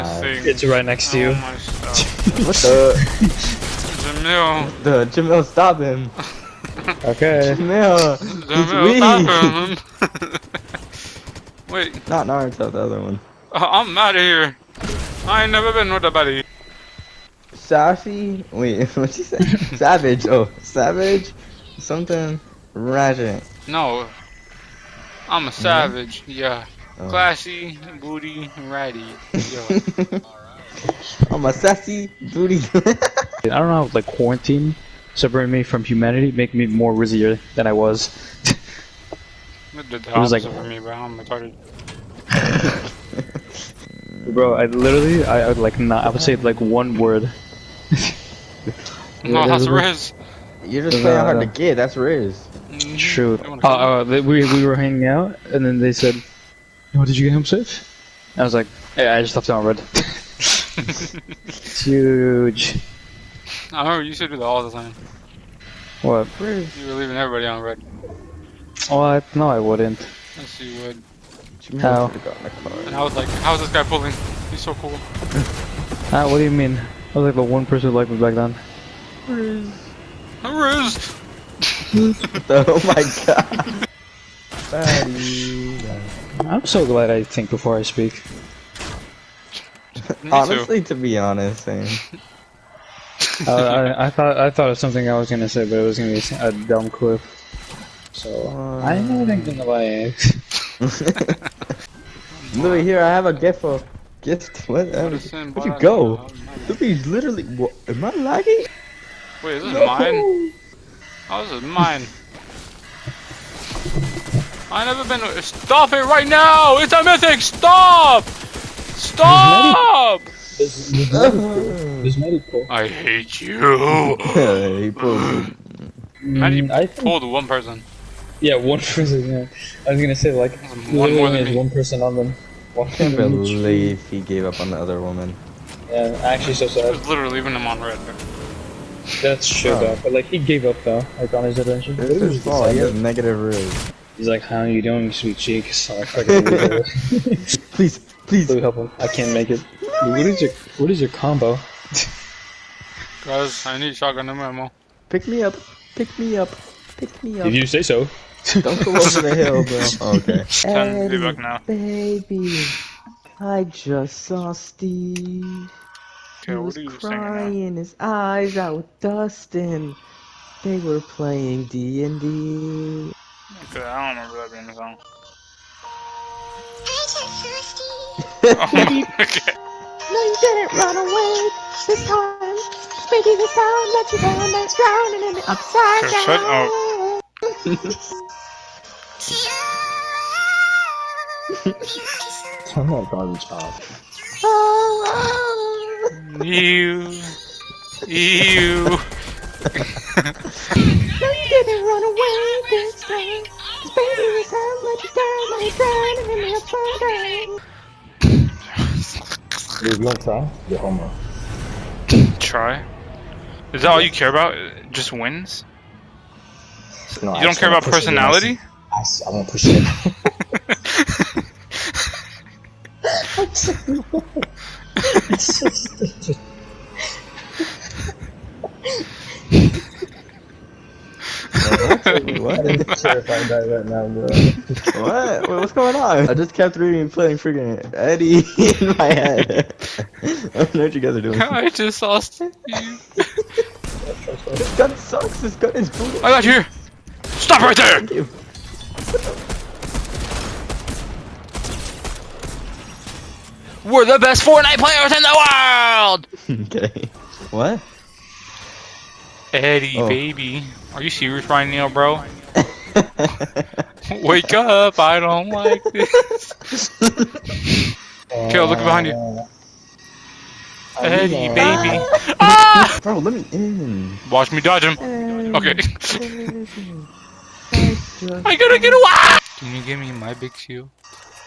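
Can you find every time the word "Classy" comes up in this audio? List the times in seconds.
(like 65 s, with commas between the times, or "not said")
27 s.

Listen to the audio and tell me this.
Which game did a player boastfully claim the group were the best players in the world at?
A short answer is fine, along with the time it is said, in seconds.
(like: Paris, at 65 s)
Fortnite, at 254 s.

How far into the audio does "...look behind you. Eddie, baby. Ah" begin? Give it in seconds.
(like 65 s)
268 s.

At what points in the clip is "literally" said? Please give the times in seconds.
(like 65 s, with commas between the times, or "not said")
44 s, 107 s, 137 s.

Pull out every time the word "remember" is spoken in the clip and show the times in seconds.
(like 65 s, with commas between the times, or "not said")
63 s, 174 s.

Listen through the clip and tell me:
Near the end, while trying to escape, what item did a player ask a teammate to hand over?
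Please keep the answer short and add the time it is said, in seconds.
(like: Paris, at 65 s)
Big shield, at 280 s.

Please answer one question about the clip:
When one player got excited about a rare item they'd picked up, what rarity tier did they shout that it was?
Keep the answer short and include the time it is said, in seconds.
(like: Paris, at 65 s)
Mythic, at 117 s.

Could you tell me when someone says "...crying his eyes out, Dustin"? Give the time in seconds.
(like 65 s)
166 s.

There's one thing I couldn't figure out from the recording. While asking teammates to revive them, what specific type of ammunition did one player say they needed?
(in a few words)
Shotgun ammo.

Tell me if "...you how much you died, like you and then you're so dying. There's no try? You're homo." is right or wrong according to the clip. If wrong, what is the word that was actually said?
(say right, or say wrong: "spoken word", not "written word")
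right.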